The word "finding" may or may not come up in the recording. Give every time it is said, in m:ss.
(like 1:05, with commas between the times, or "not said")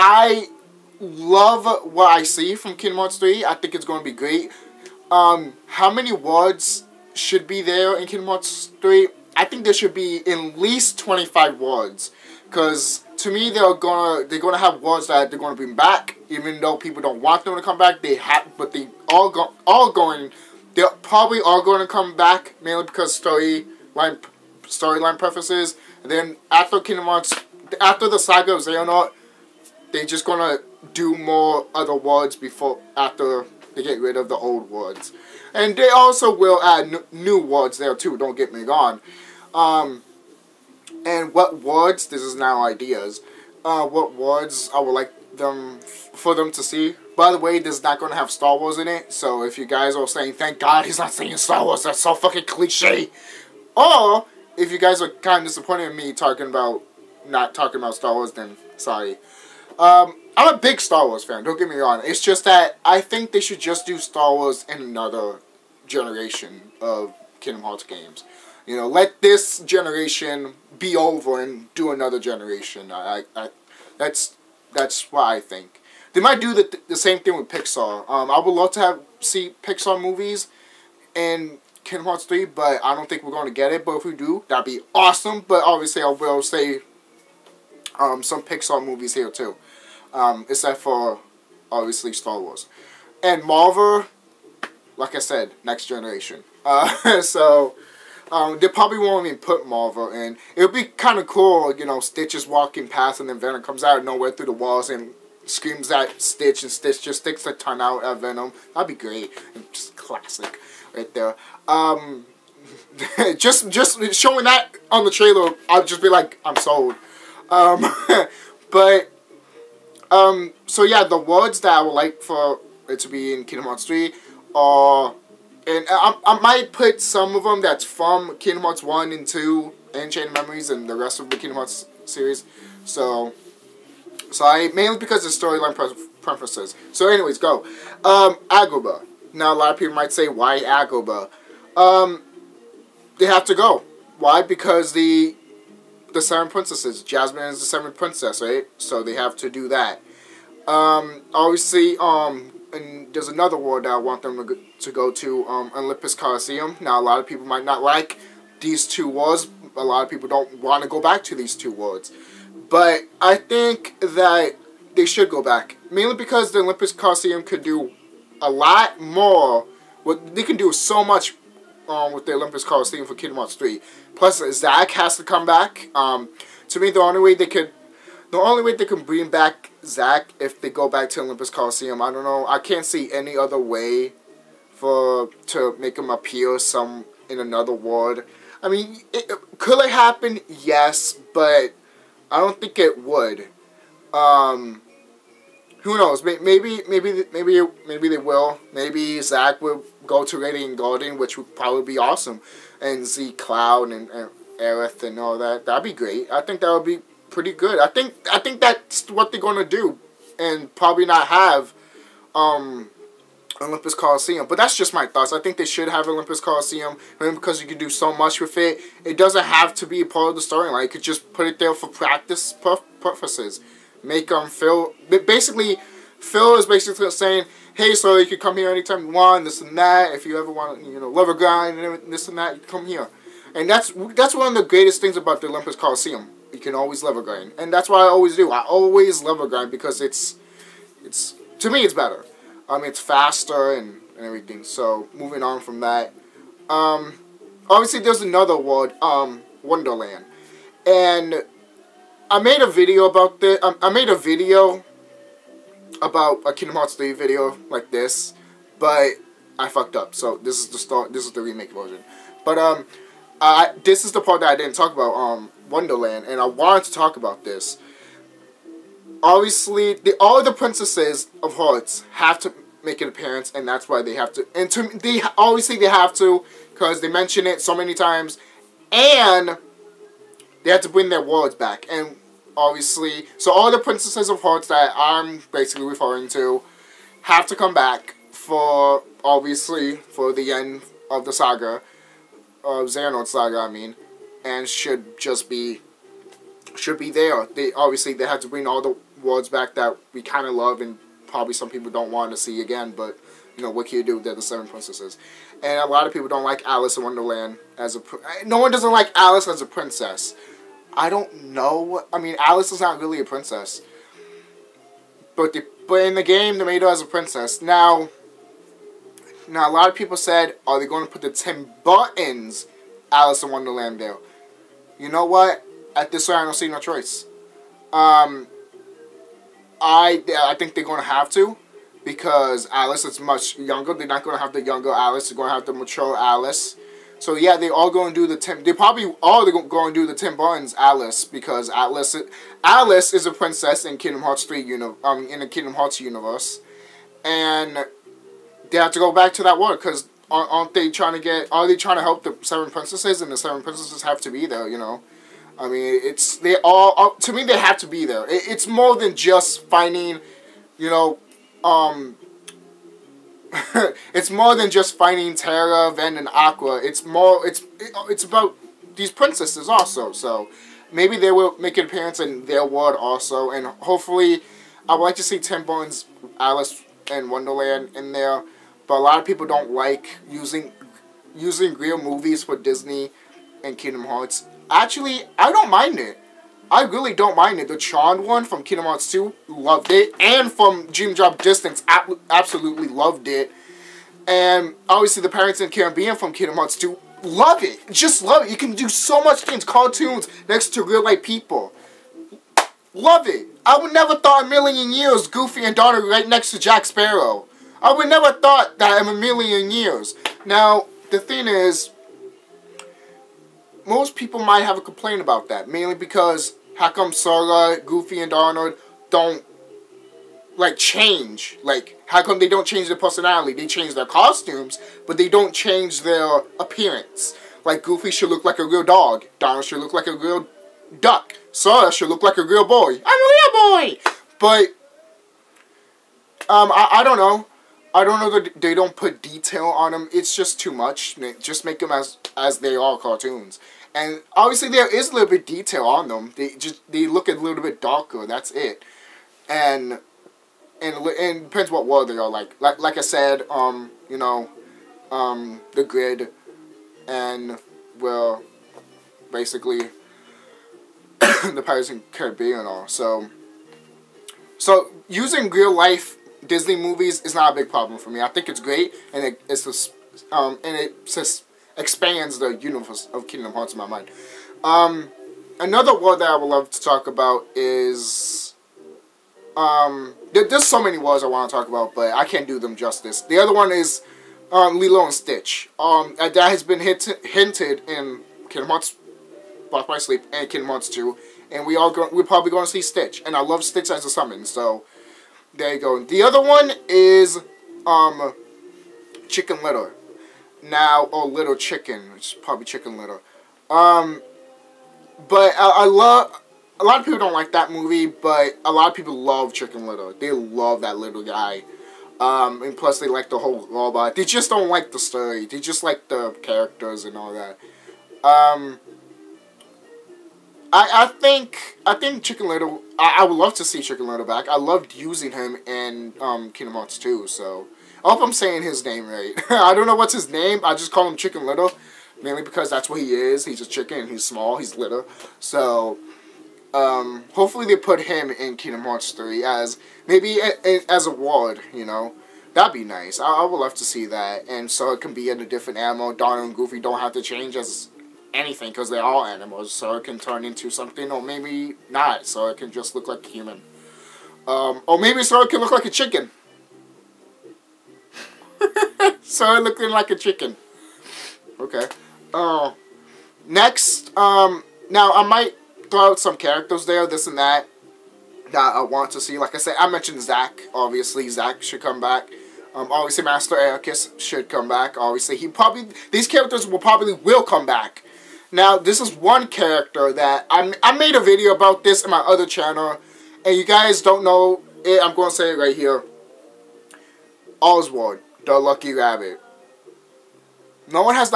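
5:59, 6:04.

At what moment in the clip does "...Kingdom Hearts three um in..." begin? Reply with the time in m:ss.
5:43.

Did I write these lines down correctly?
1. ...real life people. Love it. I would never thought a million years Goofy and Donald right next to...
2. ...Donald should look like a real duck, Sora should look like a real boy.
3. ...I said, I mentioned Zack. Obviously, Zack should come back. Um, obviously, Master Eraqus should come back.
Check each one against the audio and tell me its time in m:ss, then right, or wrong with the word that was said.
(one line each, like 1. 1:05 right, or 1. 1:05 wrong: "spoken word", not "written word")
1. 6:40 right
2. 7:09 right
3. 9:29 right.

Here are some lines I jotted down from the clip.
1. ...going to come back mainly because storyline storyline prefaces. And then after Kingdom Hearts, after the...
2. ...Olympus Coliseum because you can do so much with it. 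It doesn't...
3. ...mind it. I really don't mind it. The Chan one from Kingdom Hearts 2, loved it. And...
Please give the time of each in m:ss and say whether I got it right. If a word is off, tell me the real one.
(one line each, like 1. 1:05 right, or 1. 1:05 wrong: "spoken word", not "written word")
1. 0:21 right
2. 3:36 right
3. 6:25 right.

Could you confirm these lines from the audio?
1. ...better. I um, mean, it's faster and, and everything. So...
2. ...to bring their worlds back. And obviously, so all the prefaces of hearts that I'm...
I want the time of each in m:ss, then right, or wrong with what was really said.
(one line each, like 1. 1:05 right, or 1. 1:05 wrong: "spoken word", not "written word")
1. 4:01 right
2. 4:40 wrong: "princesses", not "prefaces".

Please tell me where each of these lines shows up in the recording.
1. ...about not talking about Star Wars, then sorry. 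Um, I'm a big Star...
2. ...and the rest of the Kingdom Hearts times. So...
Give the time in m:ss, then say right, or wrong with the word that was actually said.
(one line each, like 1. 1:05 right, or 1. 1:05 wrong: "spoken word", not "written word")
1. 0:56 right
2. 2:10 wrong: "series", not "times".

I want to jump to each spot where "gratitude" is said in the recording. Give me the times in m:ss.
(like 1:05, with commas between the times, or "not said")
not said.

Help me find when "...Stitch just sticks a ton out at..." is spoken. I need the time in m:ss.
1:46.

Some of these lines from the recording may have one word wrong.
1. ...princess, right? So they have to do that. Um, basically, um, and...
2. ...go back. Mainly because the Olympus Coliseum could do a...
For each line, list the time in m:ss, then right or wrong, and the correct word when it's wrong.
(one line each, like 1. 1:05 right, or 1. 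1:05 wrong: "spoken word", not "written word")
1. 2:27 wrong: "obviously", not "basically"
2. 2:45 right.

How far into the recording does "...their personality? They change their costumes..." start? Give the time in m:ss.
7:02.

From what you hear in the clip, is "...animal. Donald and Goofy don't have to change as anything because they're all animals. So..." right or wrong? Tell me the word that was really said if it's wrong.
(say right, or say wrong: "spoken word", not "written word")
right.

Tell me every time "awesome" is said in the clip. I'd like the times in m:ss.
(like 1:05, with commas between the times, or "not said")
1:24, 3:21.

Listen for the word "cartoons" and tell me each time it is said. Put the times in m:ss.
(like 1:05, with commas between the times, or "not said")
6:39, 7:22.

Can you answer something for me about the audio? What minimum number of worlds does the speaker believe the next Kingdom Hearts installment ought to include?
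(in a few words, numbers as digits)
25.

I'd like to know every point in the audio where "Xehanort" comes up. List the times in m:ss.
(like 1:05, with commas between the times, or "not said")
0:28, 4:52.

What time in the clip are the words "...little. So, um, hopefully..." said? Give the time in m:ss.
8:54.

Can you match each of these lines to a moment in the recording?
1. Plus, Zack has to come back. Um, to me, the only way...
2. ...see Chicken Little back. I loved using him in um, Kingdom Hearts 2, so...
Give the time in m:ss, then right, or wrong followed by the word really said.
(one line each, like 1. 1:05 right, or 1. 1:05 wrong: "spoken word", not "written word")
1. 2:54 right
2. 8:43 right.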